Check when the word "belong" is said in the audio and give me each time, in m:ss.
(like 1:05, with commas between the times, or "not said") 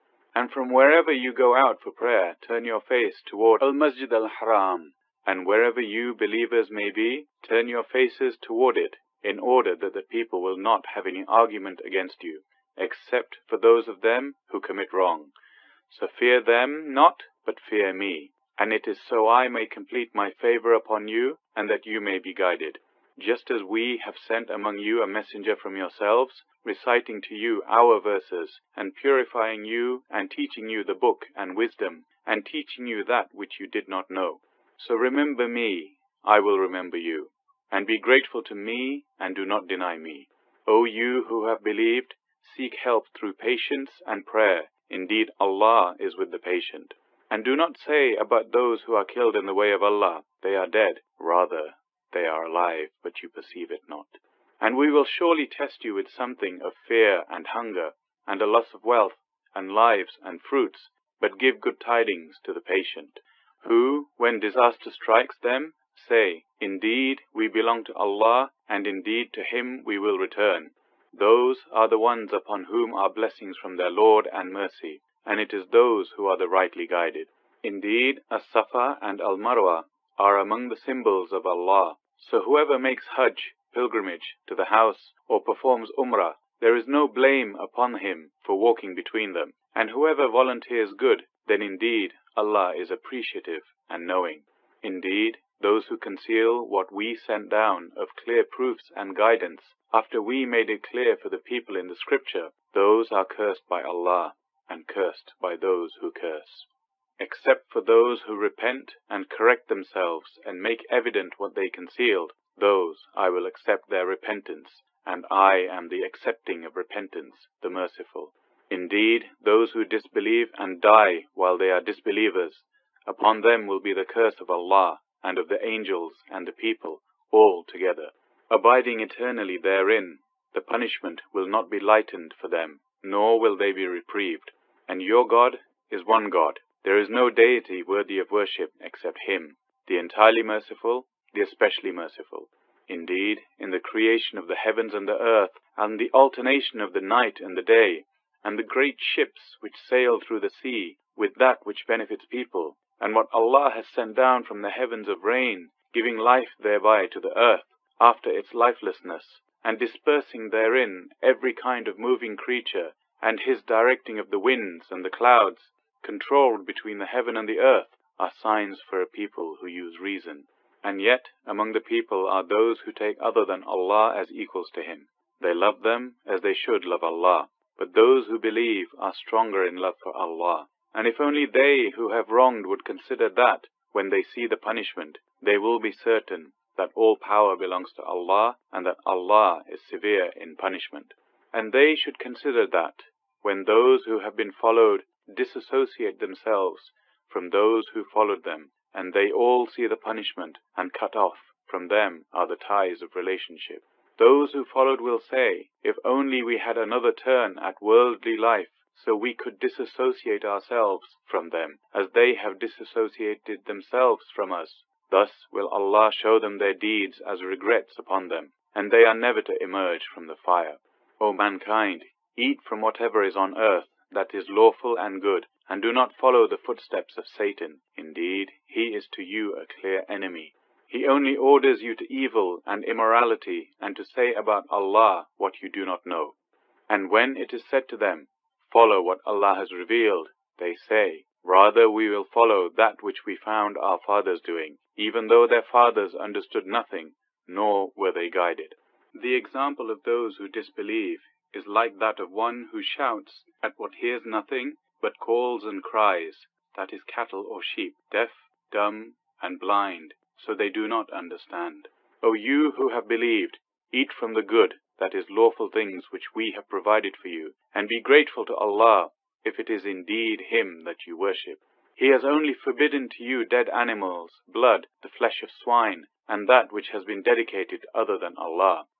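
1:07, 3:07.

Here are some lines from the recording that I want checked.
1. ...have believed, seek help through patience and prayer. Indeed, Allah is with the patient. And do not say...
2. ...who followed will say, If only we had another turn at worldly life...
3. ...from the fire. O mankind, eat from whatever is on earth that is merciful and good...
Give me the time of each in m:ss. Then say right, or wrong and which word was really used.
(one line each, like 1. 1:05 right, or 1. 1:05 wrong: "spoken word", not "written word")
1. 0:41 right
2. 3:24 right
3. 3:40 wrong: "lawful", not "merciful".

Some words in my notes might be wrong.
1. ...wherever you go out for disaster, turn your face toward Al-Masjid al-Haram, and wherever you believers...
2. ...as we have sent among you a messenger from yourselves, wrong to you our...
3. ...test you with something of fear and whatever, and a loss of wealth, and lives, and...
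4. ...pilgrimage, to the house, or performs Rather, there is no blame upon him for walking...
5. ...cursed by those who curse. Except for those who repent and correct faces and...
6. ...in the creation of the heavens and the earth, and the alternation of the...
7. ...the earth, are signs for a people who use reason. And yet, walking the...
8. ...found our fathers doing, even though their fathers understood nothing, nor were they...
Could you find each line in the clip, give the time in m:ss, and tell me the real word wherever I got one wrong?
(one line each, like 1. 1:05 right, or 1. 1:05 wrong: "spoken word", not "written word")
1. 0:00 wrong: "prayer", not "disaster"
2. 0:23 wrong: "reciting", not "wrong"
3. 0:55 wrong: "hunger", not "whatever"
4. 1:23 wrong: "Umrah", not "Rather"
5. 1:44 wrong: "themselves", not "faces"
6. 2:23 right
7. 2:47 wrong: "among", not "walking"
8. 4:03 right.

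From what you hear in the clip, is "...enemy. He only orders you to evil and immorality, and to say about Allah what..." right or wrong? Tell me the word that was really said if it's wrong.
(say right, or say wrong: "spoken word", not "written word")
right.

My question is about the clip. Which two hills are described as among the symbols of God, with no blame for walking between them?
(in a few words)
As-Safa and Al-Marwa.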